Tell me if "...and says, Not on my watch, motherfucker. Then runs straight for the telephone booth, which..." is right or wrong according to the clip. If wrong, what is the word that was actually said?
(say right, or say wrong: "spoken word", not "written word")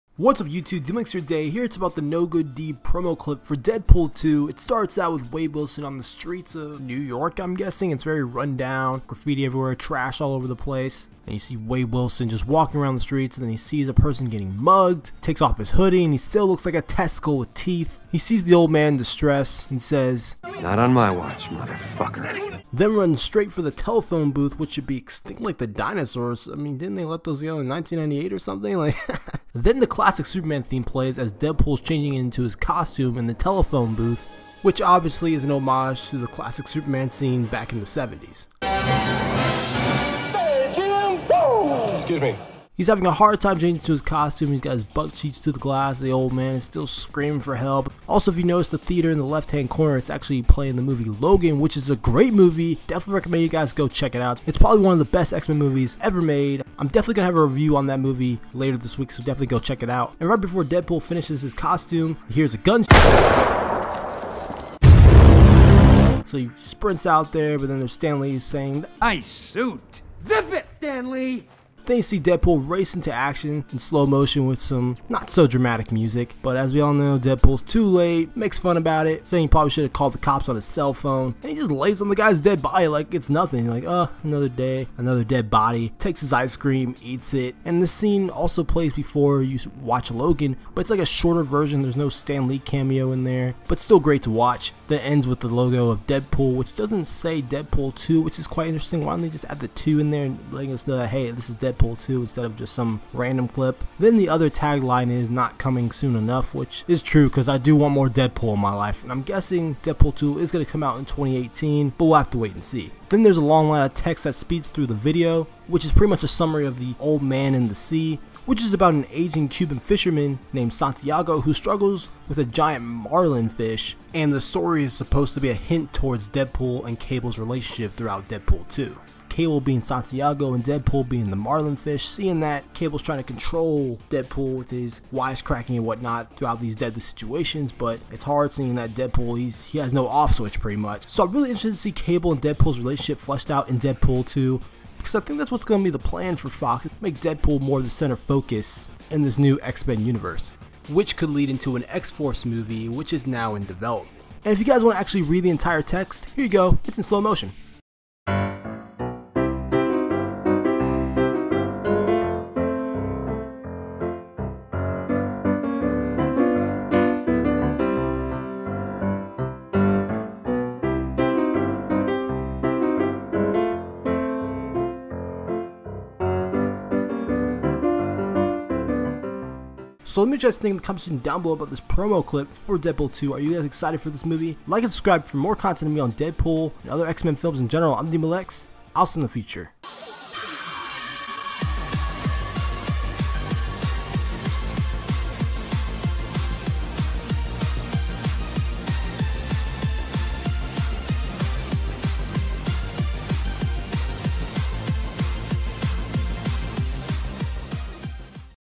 right.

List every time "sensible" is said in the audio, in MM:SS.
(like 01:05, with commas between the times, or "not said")
not said.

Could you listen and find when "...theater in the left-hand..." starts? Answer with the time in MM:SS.
00:48.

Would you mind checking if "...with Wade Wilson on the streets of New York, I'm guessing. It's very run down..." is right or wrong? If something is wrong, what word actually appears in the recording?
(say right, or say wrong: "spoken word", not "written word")
right.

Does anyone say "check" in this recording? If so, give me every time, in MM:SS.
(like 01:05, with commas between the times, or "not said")
00:53, 00:59.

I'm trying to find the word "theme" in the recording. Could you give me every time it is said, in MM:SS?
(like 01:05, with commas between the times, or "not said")
00:30.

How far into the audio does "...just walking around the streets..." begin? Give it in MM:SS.
00:12.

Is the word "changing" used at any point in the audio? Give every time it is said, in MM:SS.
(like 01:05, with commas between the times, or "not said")
00:31, 00:43.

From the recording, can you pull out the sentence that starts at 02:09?
Cable being Santiago and Deadpool being the Marlin fish.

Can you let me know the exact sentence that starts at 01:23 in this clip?
Like, uh, oh, another day, another dead body.